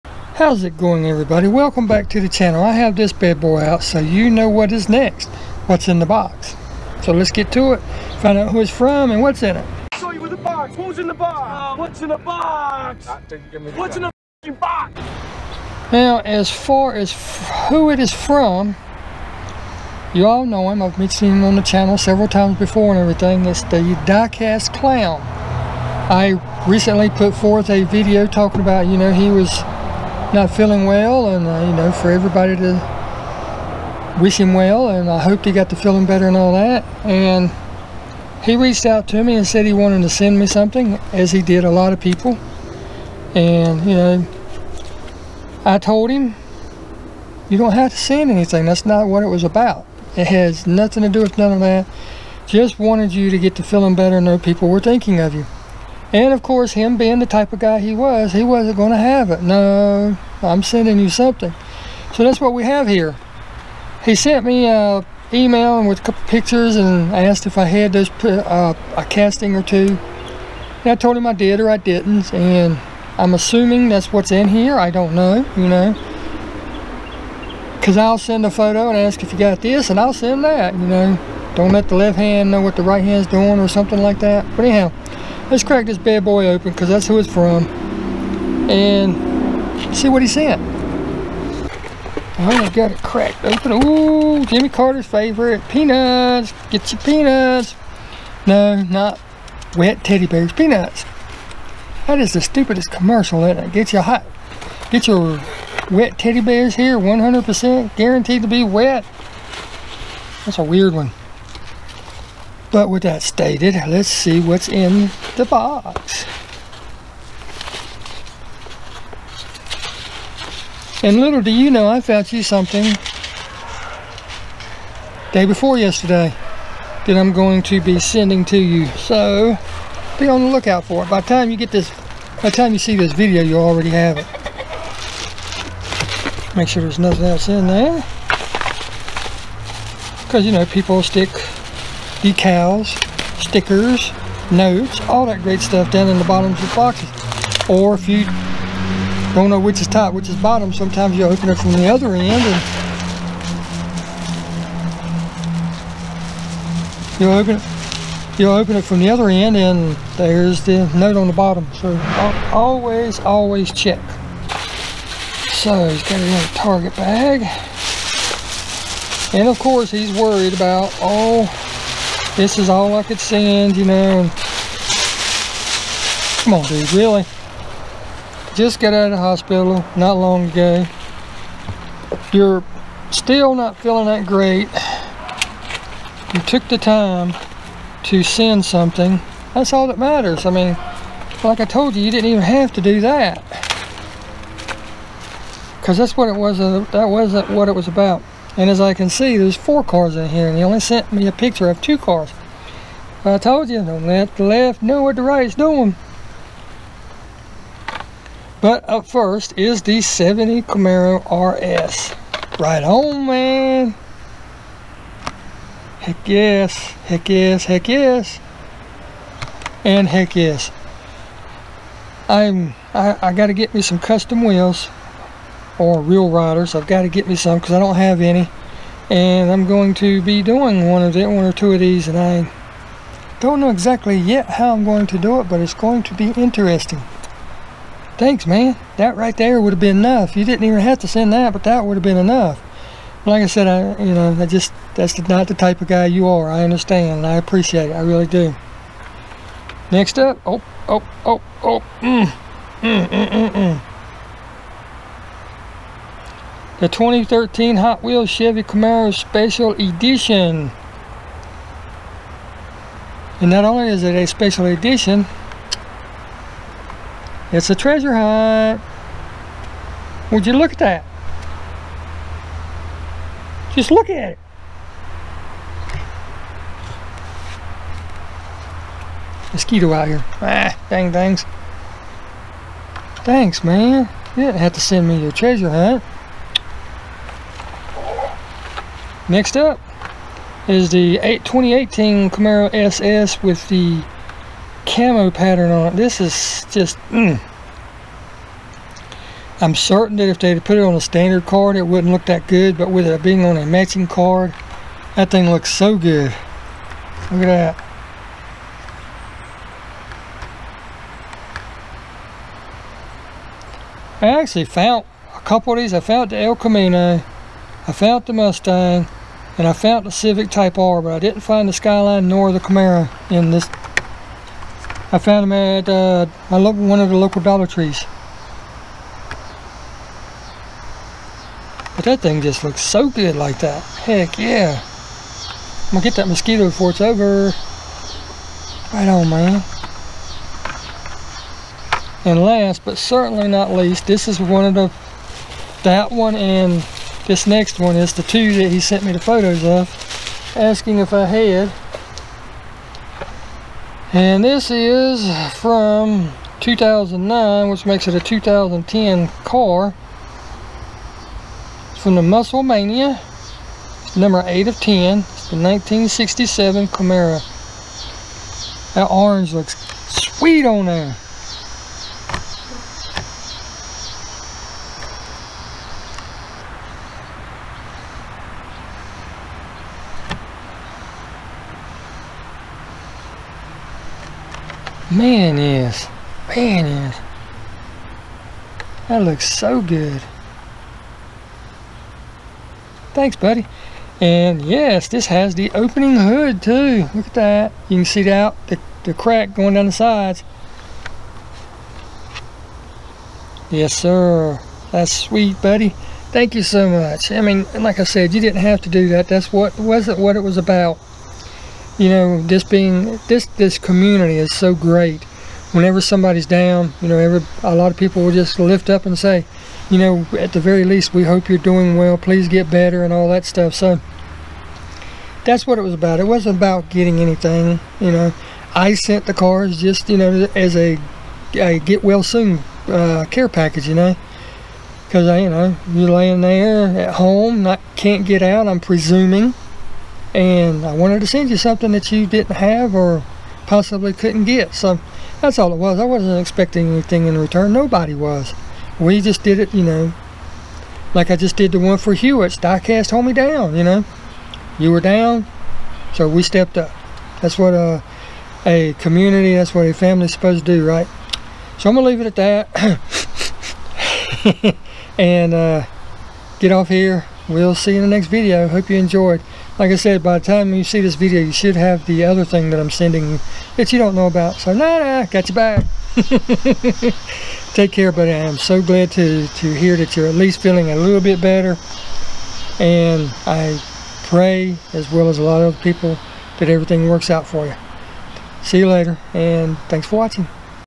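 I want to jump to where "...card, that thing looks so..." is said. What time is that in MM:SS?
05:04.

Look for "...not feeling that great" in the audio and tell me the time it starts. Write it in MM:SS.
03:03.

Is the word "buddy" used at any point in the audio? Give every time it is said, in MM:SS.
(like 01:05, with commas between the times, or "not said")
06:33, 06:45, 07:58.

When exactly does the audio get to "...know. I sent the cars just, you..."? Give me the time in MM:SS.
07:08.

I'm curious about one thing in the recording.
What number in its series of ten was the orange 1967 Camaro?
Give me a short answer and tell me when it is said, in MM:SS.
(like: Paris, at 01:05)
8, at 06:04.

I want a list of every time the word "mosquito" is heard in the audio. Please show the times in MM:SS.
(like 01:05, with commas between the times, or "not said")
04:39, 05:36.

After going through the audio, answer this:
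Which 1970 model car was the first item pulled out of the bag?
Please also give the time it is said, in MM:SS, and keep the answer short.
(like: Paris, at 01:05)
70 Camaro RS, at 03:30.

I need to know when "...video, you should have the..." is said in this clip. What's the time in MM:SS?
07:51.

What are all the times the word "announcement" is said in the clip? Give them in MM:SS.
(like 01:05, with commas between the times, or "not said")
not said.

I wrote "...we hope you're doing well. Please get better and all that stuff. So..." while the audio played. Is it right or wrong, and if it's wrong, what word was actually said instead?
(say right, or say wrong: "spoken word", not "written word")
right.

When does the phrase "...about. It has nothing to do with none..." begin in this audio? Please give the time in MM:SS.
00:49.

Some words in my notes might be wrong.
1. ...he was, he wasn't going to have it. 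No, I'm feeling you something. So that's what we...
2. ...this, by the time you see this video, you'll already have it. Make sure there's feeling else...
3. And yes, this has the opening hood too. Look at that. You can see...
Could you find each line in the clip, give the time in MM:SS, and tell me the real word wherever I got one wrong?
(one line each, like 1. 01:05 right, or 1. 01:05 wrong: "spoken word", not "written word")
1. 00:57 wrong: "sending", not "feeling"
2. 02:11 wrong: "nothing", not "feeling"
3. 06:34 right.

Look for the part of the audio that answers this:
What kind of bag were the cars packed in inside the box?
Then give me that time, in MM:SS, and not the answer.
02:46.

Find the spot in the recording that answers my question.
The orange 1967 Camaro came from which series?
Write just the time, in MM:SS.
06:02.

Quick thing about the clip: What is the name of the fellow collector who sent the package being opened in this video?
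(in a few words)
The diecast clown.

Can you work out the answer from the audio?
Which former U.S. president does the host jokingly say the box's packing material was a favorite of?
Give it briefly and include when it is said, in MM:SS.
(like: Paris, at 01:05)
Jimmy Carter, at 01:34.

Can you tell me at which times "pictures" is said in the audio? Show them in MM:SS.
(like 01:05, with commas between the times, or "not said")
01:06, 03:21.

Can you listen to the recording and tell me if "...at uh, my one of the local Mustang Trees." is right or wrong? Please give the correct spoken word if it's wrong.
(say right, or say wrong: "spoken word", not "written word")
wrong: "Dollar", not "Mustang".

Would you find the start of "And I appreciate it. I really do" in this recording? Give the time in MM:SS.
04:07.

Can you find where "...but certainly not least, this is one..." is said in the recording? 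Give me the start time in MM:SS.
05:42.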